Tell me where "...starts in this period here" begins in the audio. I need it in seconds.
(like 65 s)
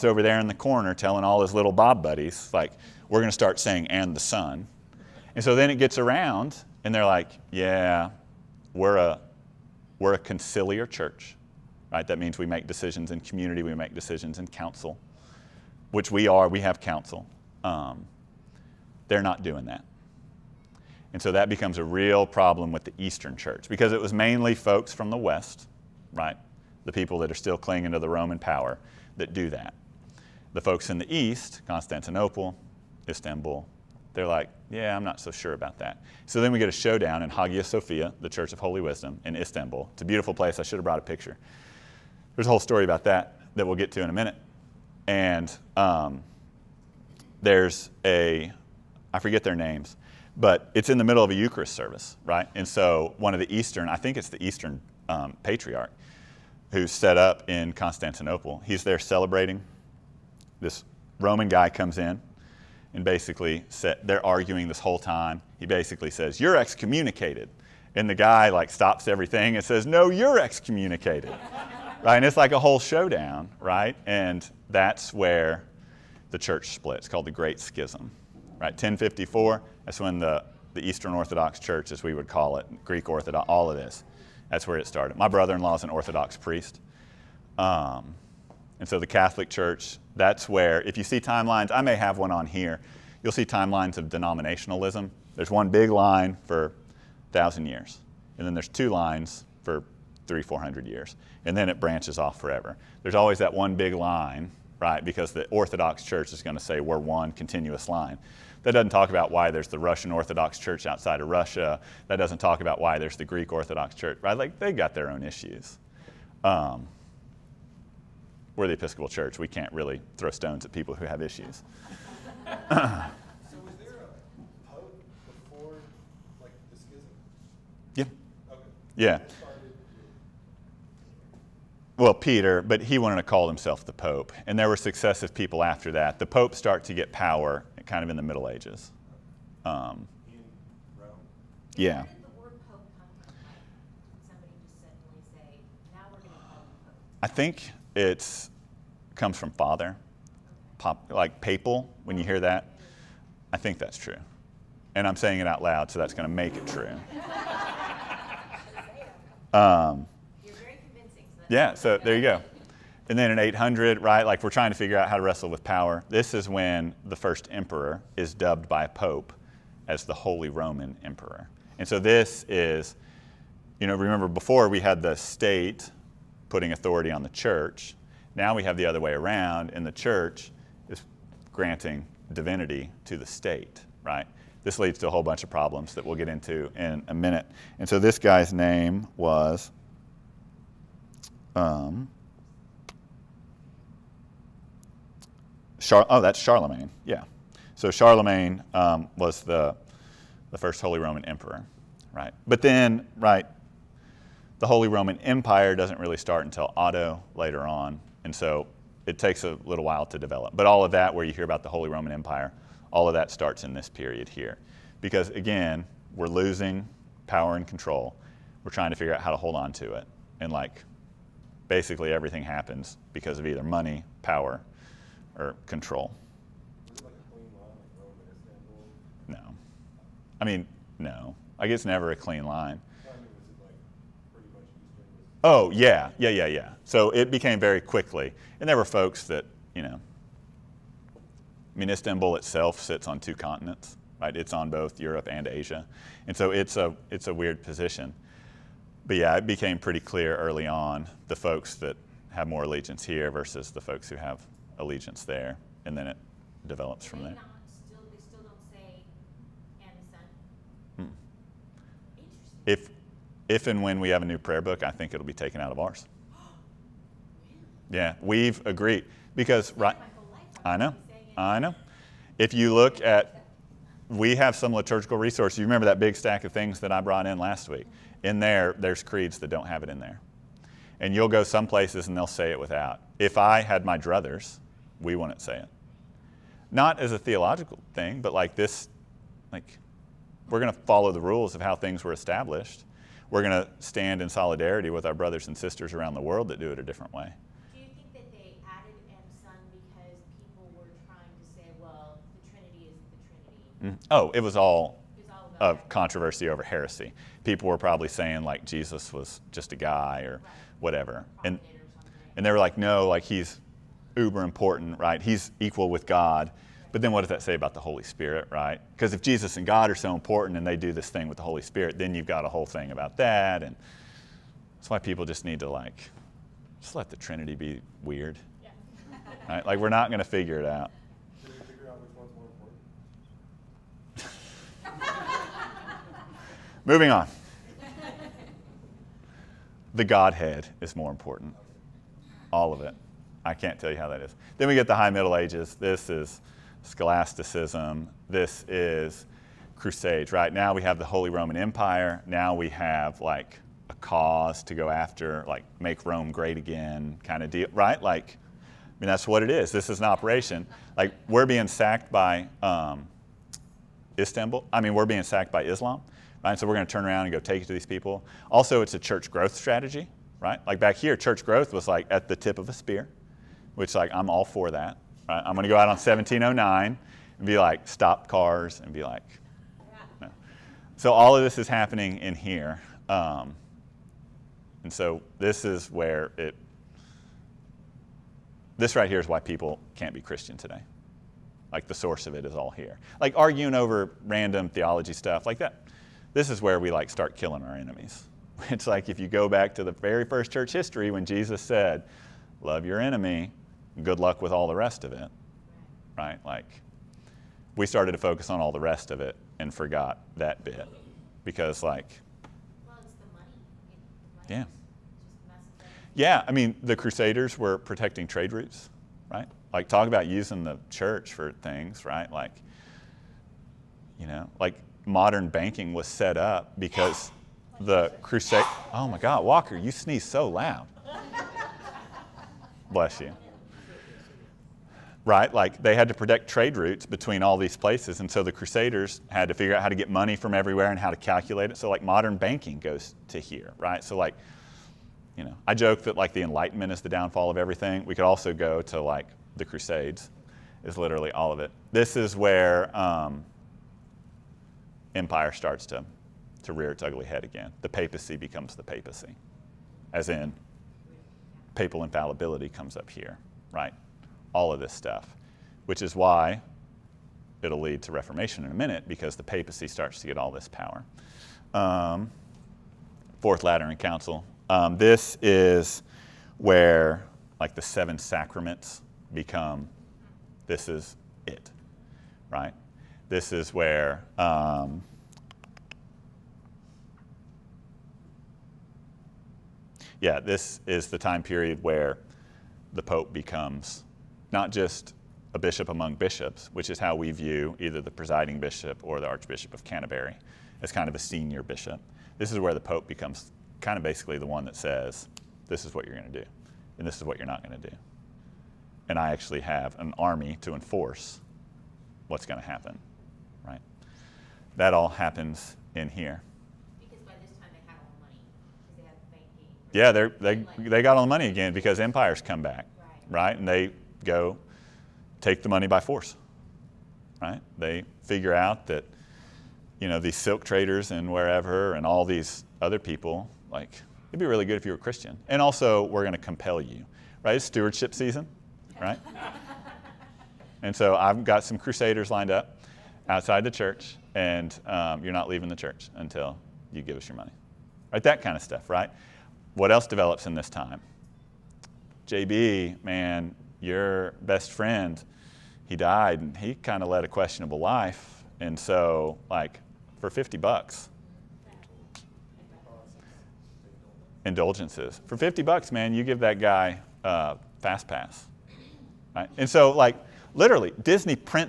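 213 s.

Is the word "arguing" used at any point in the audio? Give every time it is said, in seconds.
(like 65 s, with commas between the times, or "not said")
64 s, 393 s.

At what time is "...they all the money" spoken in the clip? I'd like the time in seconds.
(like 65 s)
517 s.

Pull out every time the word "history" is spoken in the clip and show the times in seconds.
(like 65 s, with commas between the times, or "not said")
400 s.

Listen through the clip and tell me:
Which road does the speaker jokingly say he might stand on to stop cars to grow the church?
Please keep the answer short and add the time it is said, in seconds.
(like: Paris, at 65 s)
1709, at 375 s.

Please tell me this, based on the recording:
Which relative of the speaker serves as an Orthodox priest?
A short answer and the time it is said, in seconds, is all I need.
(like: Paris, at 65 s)
Brother in law, at 85 s.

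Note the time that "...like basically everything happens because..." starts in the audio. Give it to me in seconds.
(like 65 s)
220 s.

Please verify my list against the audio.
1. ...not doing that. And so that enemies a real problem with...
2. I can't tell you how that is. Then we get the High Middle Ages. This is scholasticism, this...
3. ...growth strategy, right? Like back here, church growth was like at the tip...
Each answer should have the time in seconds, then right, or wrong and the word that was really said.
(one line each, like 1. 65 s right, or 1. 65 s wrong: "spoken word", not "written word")
1. 19 s wrong: "becomes", not "enemies"
2. 343 s right
3. 369 s right.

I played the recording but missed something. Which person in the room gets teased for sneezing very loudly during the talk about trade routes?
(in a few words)
Walker.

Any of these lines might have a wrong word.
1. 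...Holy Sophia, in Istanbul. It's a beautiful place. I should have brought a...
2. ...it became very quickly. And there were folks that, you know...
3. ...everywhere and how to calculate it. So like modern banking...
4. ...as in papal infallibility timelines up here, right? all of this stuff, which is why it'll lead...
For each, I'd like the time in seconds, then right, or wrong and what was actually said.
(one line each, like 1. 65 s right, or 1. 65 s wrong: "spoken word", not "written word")
1. 38 s wrong: "Wisdom", not "Sophia"
2. 237 s right
3. 440 s right
4. 460 s wrong: "comes", not "timelines".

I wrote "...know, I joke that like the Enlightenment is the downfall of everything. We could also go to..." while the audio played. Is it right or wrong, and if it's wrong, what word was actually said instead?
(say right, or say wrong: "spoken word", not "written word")
right.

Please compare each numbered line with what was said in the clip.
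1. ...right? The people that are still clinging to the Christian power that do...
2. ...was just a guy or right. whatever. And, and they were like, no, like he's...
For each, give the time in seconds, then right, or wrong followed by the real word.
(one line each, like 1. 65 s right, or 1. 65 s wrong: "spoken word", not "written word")
1. 26 s wrong: "Roman", not "Christian"
2. 309 s right.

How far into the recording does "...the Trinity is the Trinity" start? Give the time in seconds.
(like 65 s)
302 s.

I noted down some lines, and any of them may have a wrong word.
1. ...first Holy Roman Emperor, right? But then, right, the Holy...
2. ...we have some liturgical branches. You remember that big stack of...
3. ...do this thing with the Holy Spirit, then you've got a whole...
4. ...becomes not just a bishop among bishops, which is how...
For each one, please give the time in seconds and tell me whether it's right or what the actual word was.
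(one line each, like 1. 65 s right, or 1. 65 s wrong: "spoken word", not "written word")
1. 200 s right
2. 274 s wrong: "resources", not "branches"
3. 320 s right
4. 493 s right.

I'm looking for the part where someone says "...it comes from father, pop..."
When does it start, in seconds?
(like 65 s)
147 s.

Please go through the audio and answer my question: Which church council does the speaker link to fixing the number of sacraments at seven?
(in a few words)
Fourth Lateran Council.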